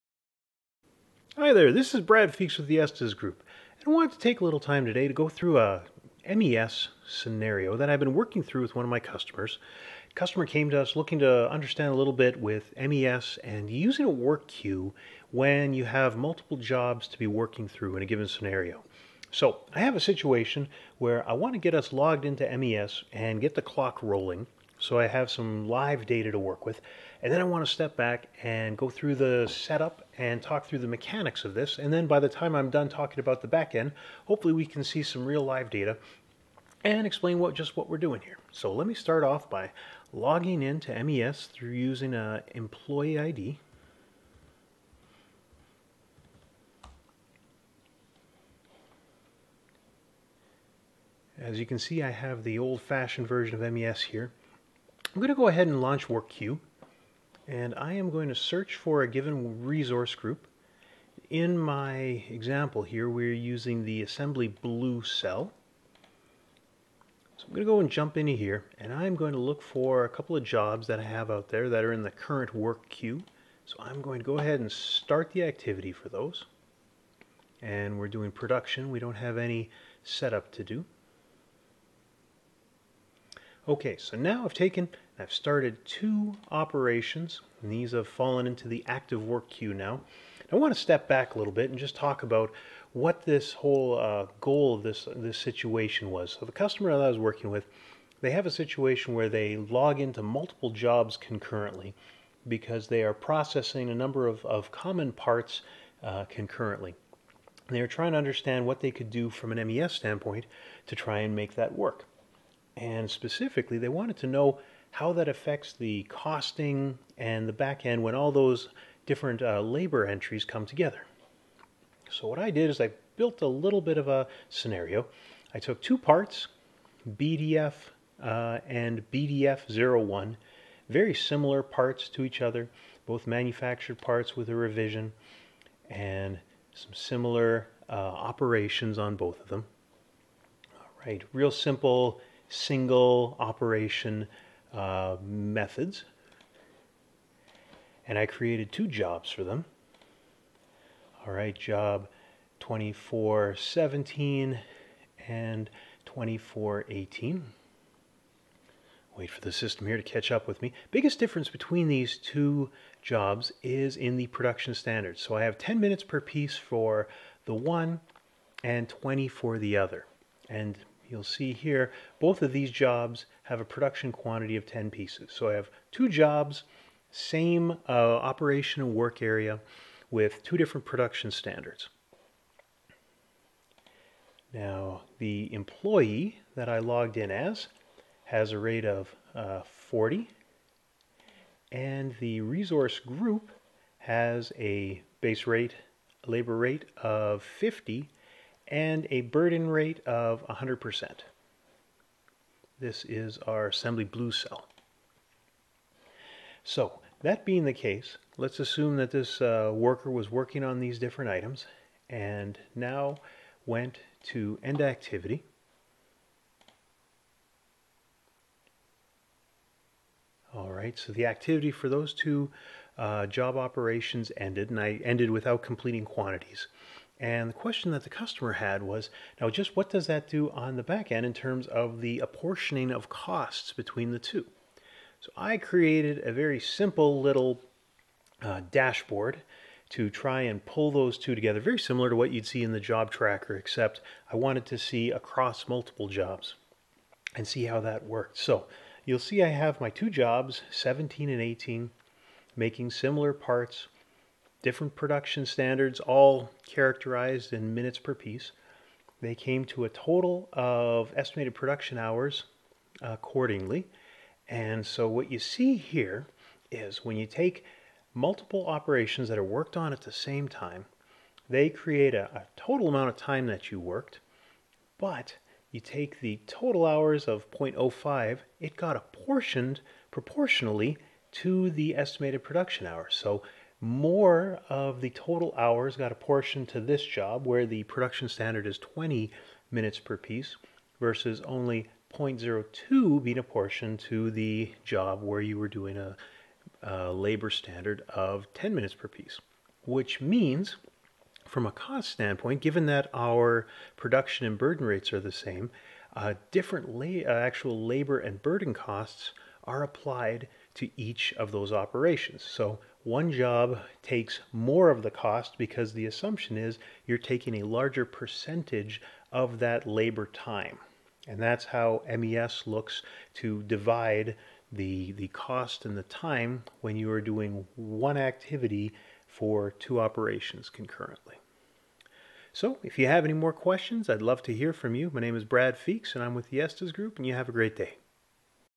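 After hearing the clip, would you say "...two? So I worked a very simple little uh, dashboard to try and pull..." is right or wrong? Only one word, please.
wrong.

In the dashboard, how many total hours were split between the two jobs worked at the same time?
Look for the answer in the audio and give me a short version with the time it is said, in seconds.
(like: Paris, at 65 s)
0.05, at 277 s.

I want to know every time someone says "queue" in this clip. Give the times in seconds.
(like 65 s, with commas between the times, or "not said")
14 s, 56 s, 72 s, 89 s.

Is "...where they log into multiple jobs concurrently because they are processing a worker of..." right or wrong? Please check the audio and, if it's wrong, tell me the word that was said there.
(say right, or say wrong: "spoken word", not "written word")
wrong: "number", not "worker".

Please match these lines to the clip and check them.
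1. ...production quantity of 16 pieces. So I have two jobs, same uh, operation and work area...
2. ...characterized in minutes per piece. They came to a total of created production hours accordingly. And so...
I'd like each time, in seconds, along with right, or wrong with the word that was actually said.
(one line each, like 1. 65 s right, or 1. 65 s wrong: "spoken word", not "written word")
1. 173 s wrong: "10", not "16"
2. 256 s wrong: "estimated", not "created".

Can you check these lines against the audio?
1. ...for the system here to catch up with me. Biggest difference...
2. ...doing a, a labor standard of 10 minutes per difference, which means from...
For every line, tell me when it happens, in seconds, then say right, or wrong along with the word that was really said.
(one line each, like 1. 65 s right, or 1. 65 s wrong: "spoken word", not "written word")
1. 159 s right
2. 295 s wrong: "piece", not "difference".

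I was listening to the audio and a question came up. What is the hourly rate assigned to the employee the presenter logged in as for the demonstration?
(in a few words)
40.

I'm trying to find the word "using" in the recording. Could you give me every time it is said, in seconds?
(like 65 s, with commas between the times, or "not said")
13 s, 41 s, 63 s.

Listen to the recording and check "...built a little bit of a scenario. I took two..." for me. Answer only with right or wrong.
right.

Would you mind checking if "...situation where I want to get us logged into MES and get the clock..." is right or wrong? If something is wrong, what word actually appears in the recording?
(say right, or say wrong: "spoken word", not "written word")
right.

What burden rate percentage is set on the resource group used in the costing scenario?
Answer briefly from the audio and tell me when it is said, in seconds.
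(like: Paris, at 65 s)
100%, at 200 s.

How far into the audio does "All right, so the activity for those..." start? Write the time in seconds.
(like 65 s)
220 s.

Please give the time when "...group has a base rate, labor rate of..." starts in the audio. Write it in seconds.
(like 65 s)
192 s.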